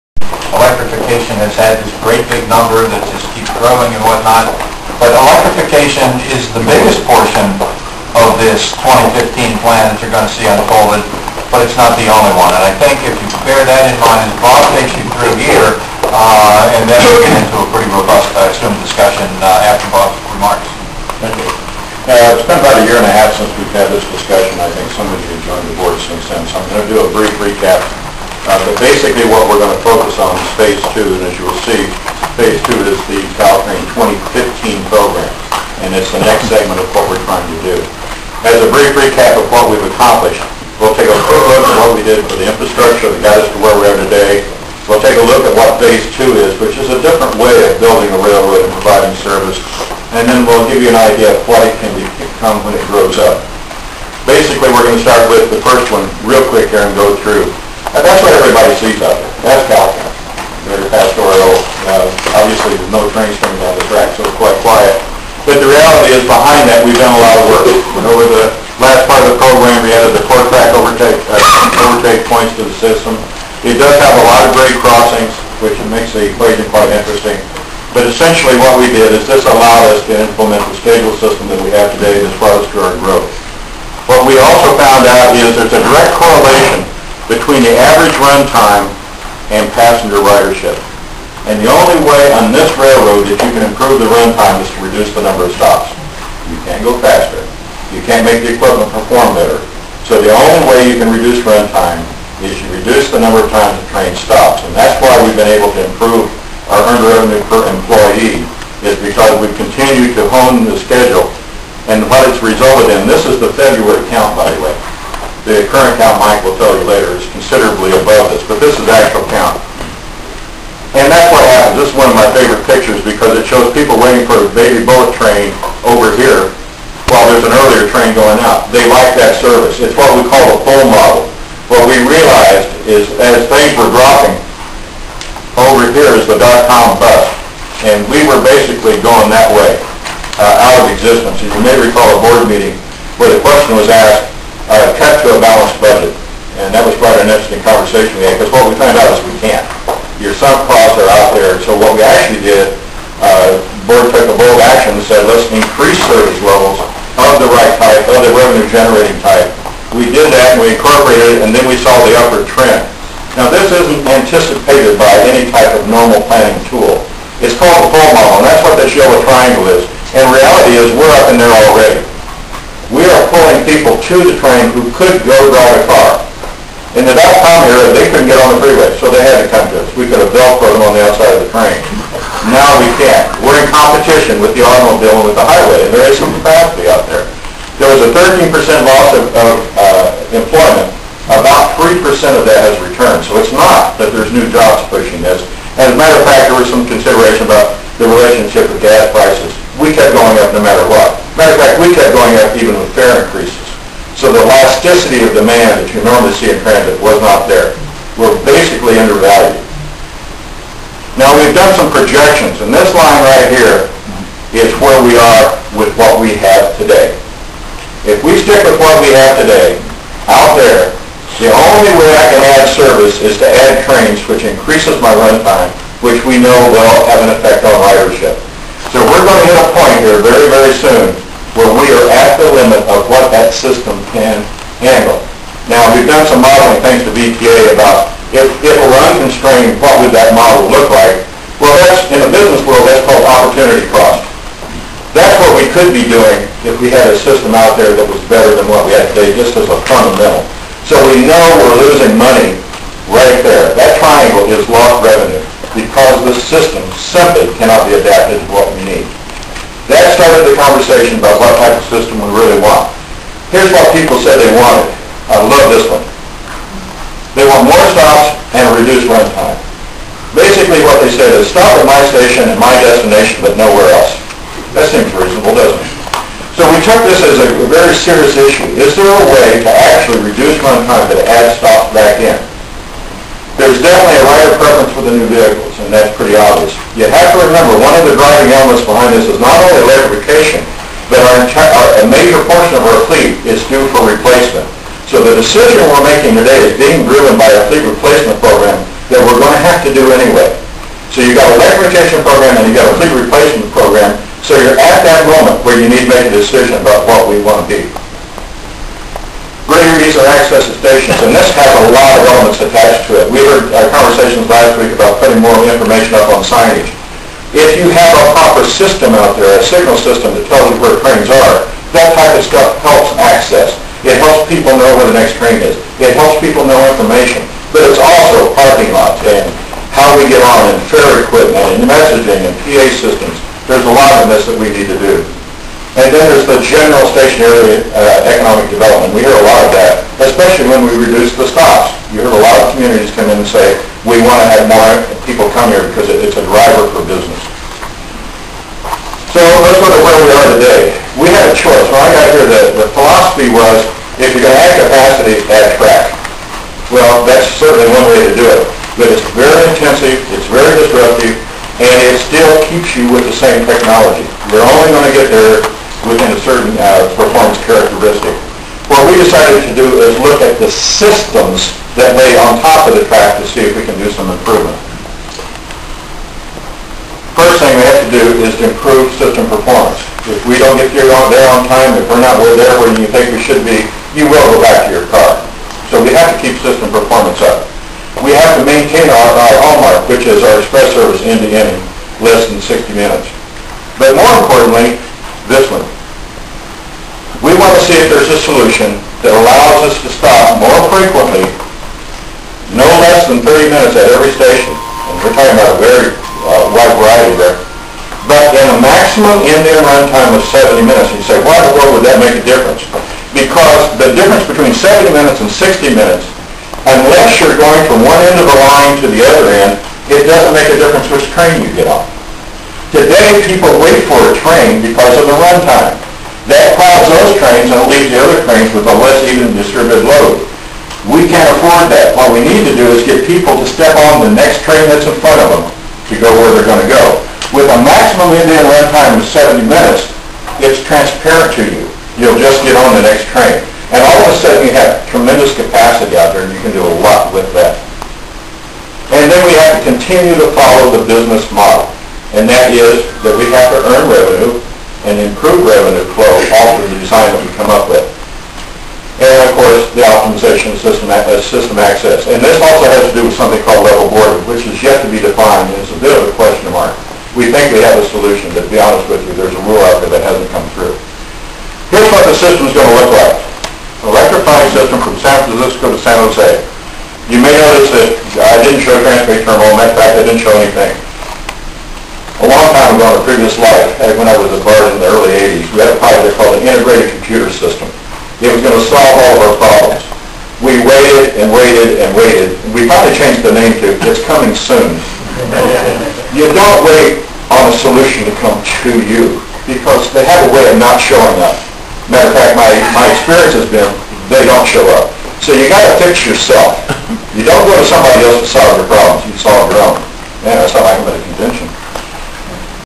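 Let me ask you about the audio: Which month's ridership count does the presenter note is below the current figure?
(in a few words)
February.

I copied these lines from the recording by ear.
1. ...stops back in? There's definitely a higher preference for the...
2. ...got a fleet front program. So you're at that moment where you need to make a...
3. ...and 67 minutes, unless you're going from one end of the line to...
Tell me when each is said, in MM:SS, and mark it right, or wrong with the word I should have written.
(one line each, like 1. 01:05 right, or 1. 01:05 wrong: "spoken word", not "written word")
1. 04:41 right
2. 05:02 wrong: "replacement", not "front"
3. 06:55 wrong: "60", not "67".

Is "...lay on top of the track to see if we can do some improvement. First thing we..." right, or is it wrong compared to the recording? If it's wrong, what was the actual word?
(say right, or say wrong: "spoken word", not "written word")
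right.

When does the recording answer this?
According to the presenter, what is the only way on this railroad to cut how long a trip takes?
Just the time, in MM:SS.
01:34.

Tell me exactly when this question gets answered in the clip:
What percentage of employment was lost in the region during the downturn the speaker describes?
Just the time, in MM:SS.
03:08.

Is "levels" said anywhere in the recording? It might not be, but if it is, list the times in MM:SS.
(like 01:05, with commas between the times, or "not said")
02:36, 07:43.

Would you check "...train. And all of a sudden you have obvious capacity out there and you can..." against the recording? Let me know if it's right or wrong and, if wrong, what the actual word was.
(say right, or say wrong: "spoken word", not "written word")
wrong: "tremendous", not "obvious".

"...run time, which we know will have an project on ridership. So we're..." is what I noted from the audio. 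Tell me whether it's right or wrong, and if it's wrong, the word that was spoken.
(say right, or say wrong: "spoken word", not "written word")
wrong: "effect", not "project".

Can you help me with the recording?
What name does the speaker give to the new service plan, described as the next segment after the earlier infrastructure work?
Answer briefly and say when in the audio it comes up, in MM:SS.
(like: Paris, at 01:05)
Caltrain 2015 program, at 00:33.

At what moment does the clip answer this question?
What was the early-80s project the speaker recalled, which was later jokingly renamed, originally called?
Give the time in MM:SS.
08:06.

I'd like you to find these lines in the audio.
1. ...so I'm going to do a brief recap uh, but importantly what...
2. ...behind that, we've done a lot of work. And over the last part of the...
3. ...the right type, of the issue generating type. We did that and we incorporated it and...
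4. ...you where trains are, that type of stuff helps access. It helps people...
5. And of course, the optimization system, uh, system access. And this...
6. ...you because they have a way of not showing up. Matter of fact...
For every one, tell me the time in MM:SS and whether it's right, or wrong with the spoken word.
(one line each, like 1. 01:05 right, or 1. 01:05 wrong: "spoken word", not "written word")
1. 00:26 wrong: "basically", not "importantly"
2. 01:06 right
3. 02:37 wrong: "revenue", not "issue"
4. 05:20 right
5. 07:39 right
6. 08:19 right.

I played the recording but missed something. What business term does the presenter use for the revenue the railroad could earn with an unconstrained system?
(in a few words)
Opportunity cost.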